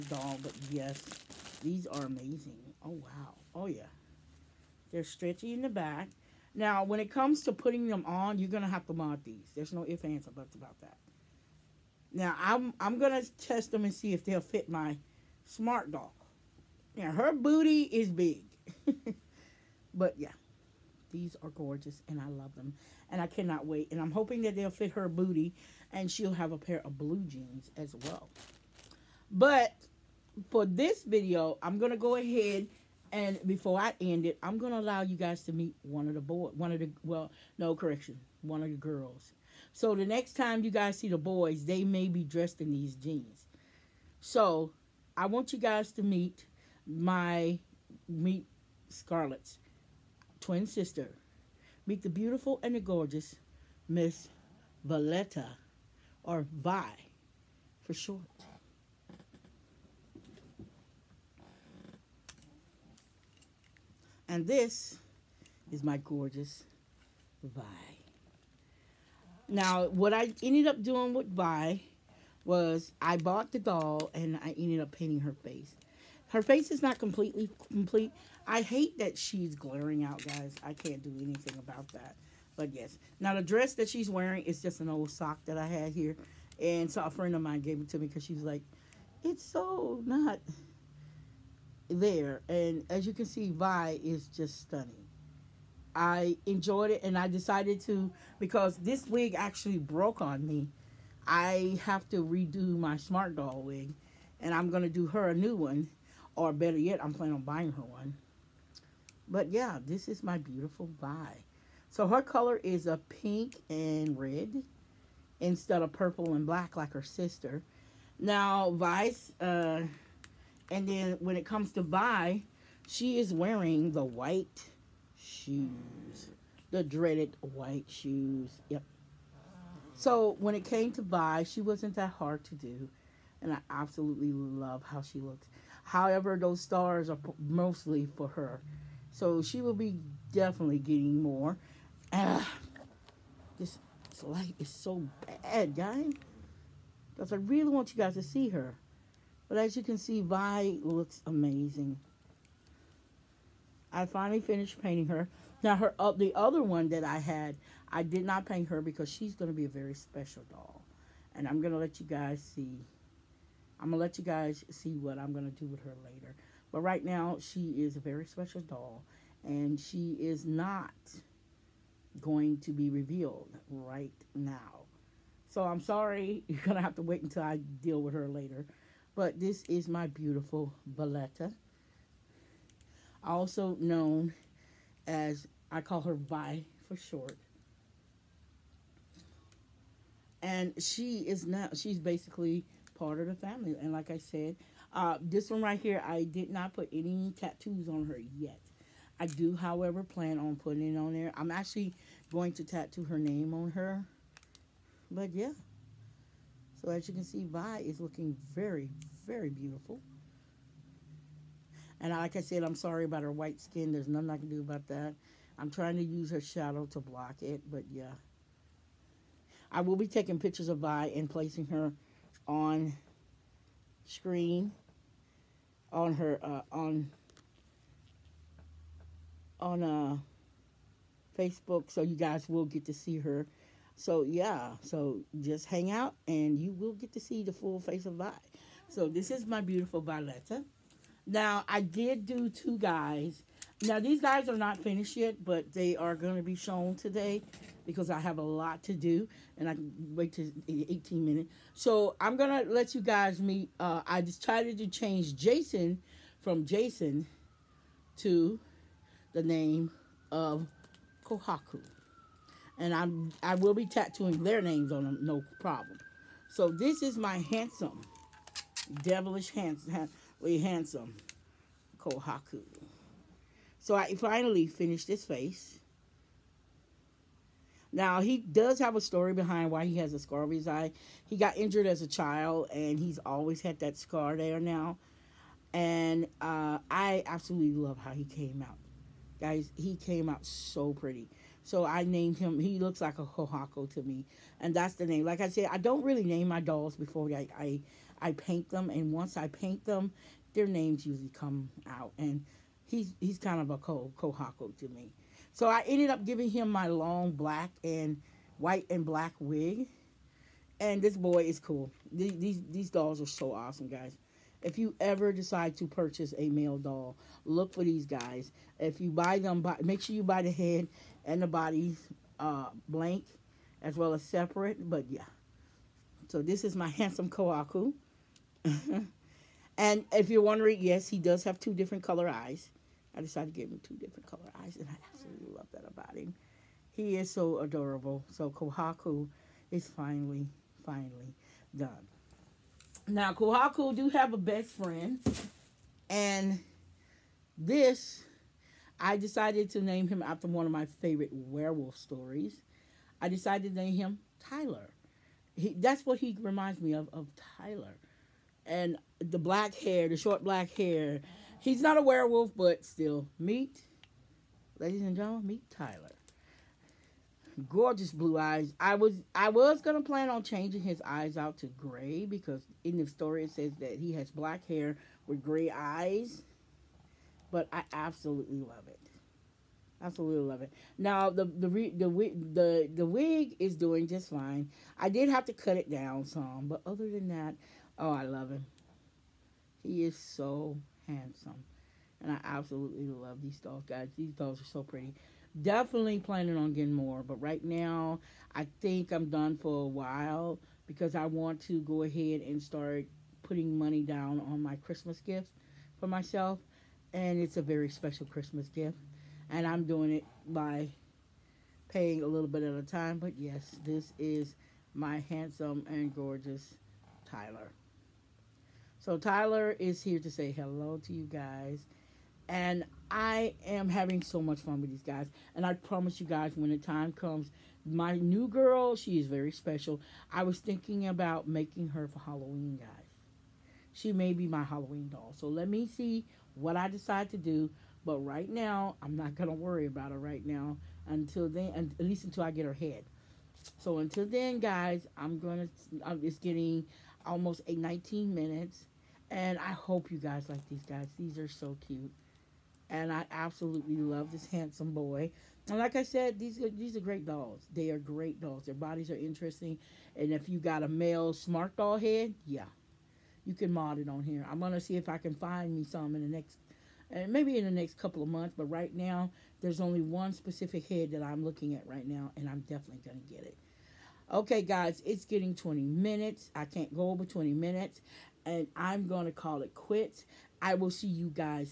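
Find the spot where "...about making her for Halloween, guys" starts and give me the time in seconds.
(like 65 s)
431 s.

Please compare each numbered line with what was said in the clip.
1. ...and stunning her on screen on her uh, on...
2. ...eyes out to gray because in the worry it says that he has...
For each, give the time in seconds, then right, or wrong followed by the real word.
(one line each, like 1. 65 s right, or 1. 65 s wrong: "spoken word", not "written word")
1. 221 s wrong: "placing", not "stunning"
2. 371 s wrong: "story", not "worry".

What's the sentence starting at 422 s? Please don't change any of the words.
And I am having so much fun with these guys.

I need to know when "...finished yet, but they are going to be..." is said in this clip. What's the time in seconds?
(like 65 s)
244 s.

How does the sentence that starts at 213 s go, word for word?
There's nothing I can do about that.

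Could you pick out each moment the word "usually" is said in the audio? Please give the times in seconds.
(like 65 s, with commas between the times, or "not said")
301 s.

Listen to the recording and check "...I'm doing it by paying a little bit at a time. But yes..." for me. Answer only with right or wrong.
right.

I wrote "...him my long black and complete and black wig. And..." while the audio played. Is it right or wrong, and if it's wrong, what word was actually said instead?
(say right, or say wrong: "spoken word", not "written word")
wrong: "white", not "complete".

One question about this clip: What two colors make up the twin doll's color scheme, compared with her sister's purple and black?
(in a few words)
Pink and red.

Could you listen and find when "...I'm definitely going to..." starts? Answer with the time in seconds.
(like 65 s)
472 s.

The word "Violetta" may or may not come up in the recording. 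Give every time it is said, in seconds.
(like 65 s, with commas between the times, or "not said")
54 s, 180 s, 239 s.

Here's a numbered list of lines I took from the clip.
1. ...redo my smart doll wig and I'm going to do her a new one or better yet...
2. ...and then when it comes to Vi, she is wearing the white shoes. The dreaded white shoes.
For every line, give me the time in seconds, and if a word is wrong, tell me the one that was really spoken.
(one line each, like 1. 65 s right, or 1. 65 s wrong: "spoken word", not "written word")
1. 102 s right
2. 120 s right.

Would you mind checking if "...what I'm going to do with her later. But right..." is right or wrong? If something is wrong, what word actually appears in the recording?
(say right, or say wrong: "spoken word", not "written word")
right.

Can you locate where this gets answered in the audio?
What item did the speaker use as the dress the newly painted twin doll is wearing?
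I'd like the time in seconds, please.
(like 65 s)
84 s.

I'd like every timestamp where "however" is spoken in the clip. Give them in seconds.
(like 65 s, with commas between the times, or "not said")
135 s, 199 s.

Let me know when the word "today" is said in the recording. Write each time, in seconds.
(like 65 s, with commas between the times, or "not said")
246 s.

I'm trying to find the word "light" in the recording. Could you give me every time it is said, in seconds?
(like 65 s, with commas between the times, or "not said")
144 s.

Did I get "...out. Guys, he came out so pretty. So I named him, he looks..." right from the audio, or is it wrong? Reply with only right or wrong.
right.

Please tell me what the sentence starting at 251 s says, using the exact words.
So I'm going to let you guys meet.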